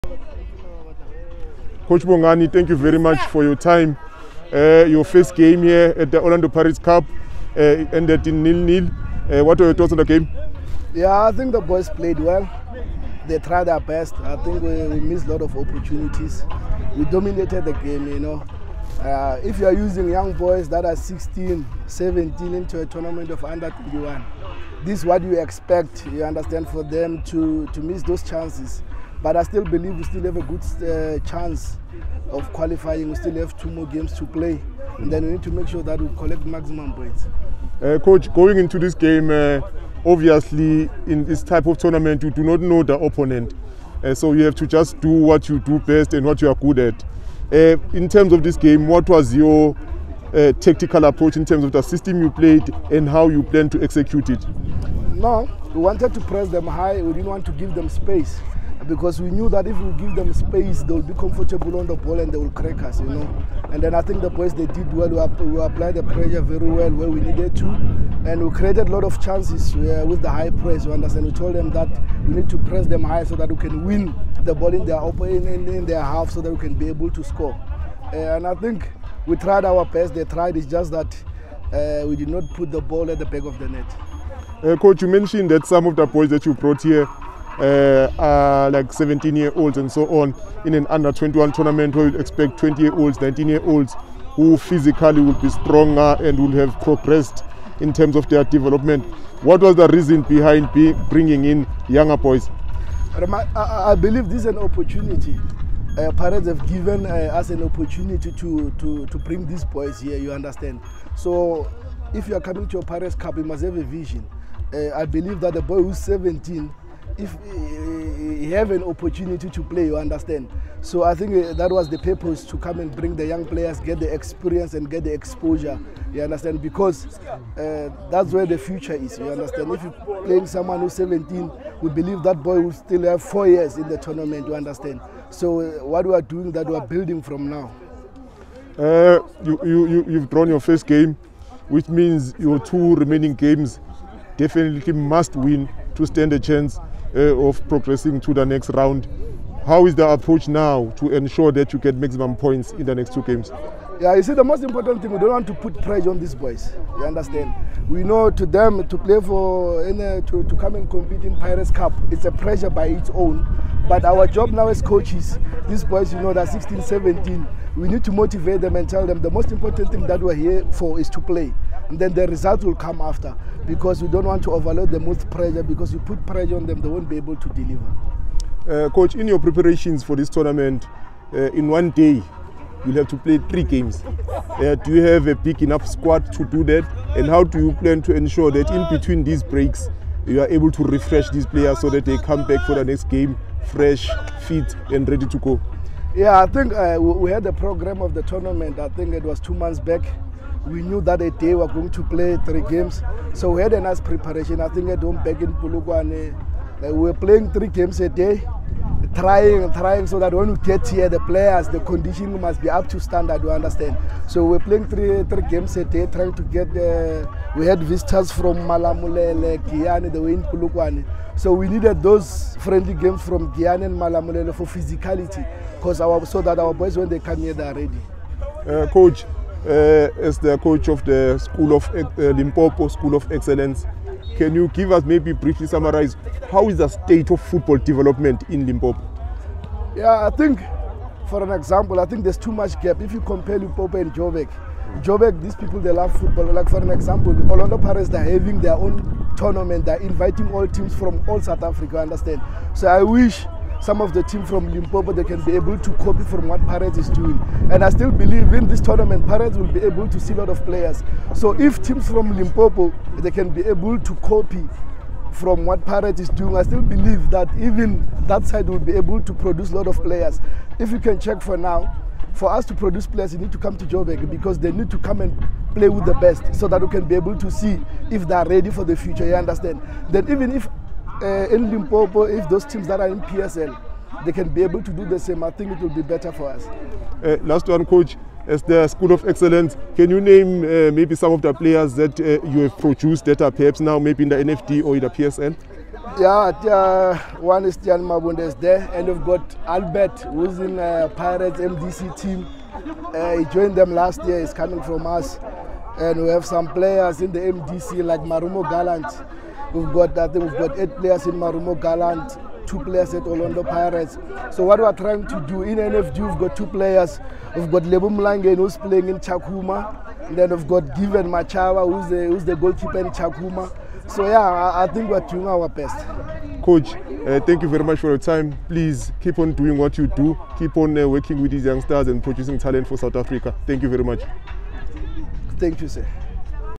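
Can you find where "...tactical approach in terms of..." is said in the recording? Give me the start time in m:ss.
0:50.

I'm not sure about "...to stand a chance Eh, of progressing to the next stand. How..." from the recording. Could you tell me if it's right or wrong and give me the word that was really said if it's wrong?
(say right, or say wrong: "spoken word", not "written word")
wrong: "round", not "stand".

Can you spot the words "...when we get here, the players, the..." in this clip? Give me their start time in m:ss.
3:30.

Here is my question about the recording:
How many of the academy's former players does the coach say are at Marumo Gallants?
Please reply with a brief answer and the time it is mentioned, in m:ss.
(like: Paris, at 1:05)
8, at 5:10.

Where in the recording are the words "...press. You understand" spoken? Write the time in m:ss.
1:10.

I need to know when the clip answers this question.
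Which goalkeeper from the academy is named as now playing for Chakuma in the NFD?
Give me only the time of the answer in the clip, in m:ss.
5:20.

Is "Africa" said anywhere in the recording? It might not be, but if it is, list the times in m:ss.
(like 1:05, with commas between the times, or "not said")
4:11, 5:33.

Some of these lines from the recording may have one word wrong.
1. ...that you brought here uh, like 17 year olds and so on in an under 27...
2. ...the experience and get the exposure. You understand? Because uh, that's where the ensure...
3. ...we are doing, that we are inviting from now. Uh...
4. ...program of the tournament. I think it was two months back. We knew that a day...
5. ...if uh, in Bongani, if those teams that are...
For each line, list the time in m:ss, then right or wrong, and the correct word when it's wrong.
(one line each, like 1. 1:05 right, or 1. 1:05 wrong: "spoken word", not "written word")
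1. 1:26 wrong: "21", not "27"
2. 2:03 wrong: "future", not "ensure"
3. 2:16 wrong: "building", not "inviting"
4. 3:17 right
5. 4:40 wrong: "Limpopo", not "Bongani".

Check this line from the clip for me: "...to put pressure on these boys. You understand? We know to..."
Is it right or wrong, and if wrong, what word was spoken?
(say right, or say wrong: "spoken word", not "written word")
right.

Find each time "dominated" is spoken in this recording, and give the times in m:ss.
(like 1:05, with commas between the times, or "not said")
0:17.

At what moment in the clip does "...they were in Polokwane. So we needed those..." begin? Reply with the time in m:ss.
3:40.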